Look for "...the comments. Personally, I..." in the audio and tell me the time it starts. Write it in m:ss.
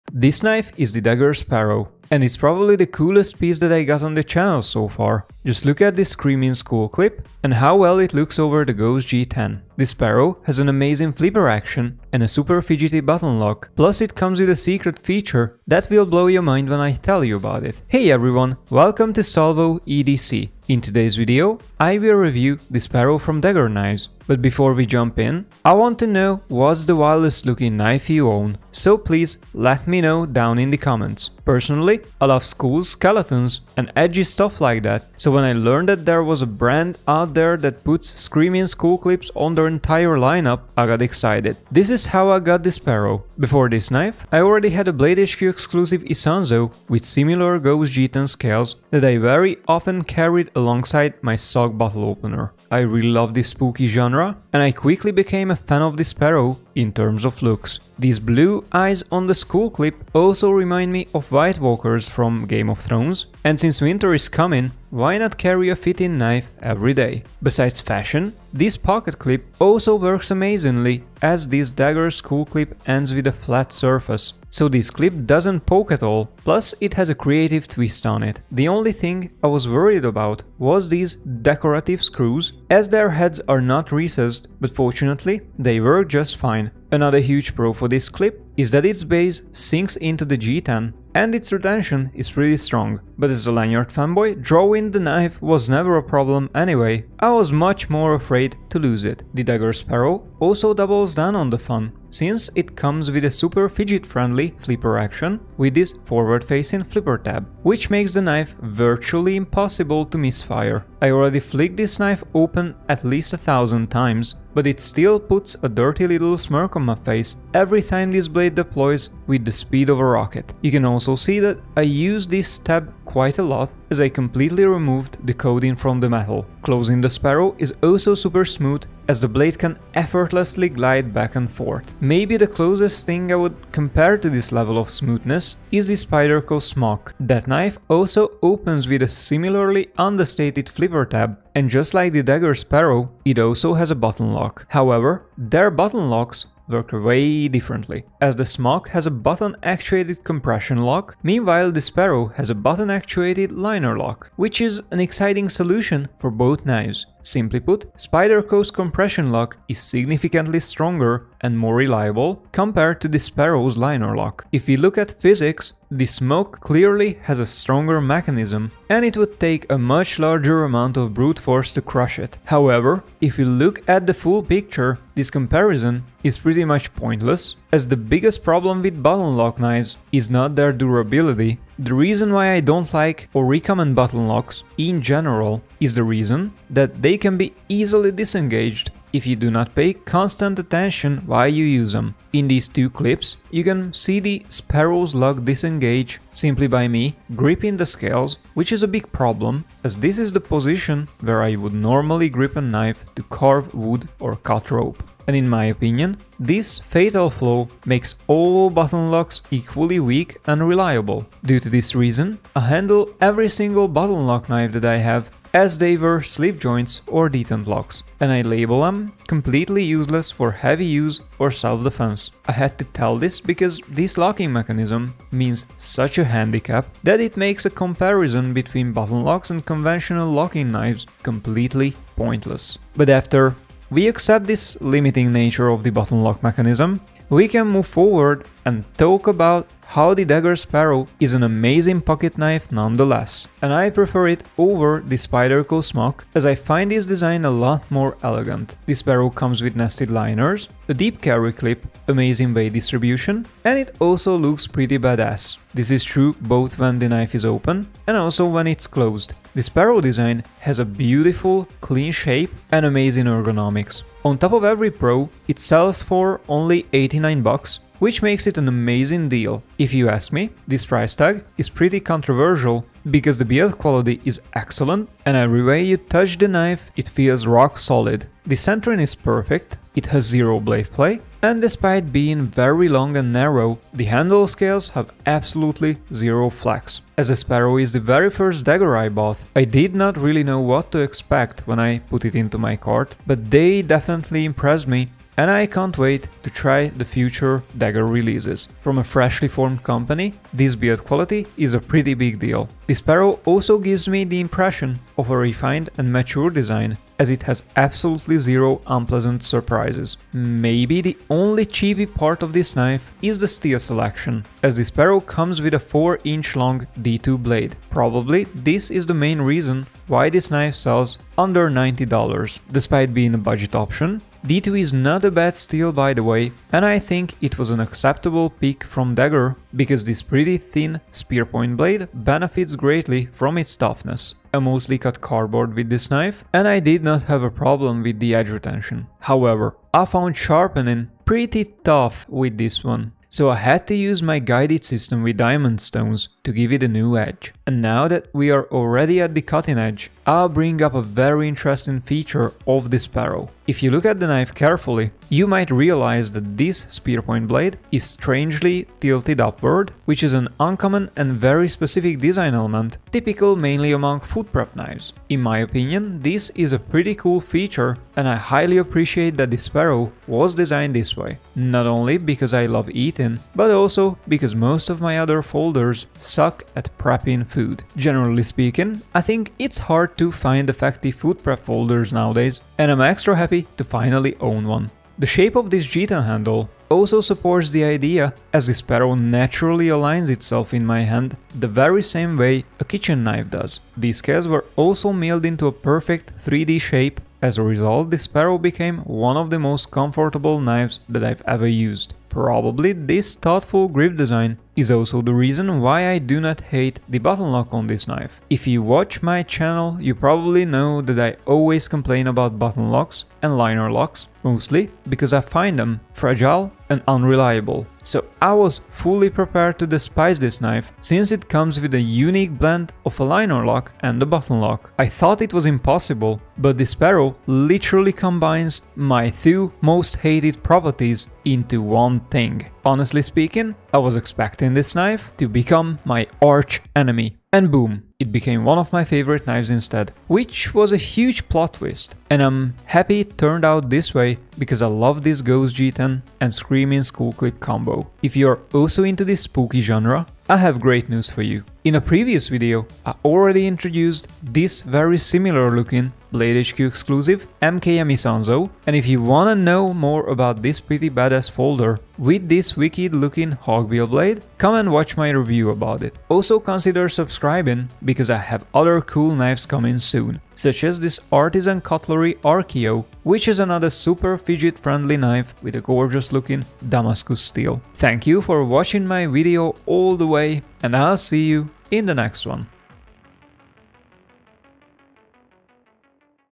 0:30.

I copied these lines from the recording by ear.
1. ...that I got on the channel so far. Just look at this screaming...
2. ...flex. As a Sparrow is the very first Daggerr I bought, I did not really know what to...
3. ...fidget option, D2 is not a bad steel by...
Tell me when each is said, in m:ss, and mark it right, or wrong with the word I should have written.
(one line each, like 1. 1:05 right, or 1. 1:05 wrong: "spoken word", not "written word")
1. 0:03 right
2. 4:46 right
3. 5:23 wrong: "budget", not "fidget".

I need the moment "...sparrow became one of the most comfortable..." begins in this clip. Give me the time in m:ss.
6:38.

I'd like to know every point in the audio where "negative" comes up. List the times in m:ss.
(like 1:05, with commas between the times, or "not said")
not said.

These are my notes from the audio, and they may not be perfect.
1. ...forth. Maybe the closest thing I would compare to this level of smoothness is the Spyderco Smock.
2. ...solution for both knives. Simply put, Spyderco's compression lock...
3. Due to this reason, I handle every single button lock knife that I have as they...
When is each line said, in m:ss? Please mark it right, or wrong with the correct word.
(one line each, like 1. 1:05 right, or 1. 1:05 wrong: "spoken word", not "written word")
1. 2:11 right
2. 2:35 right
3. 3:31 right.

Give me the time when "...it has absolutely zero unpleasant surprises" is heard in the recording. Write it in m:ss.
5:07.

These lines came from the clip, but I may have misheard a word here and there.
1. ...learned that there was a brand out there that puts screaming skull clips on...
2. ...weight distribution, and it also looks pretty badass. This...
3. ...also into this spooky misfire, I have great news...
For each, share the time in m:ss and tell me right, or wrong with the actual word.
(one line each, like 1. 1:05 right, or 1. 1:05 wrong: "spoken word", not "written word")
1. 0:35 right
2. 4:12 right
3. 7:28 wrong: "genre", not "misfire".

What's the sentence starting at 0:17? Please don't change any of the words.
Hey everyone, welcome to Salvo EDC.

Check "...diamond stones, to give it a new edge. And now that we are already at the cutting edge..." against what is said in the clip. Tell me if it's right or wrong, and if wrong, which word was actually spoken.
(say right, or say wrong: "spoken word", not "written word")
right.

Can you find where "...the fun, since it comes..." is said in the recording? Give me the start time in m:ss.
1:41.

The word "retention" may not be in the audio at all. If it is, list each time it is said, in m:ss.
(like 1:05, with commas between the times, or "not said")
1:31, 5:38.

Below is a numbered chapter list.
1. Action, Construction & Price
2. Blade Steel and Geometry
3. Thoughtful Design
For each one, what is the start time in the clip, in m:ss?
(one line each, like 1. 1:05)
1. 1:38
2. 5:09
3. 6:24.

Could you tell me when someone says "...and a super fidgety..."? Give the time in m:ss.
0:12.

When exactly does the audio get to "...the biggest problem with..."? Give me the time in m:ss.
2:57.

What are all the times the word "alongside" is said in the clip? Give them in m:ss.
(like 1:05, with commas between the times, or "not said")
0:50.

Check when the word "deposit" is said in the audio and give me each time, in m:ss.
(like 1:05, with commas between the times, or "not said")
not said.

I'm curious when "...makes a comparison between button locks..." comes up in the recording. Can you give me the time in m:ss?
3:47.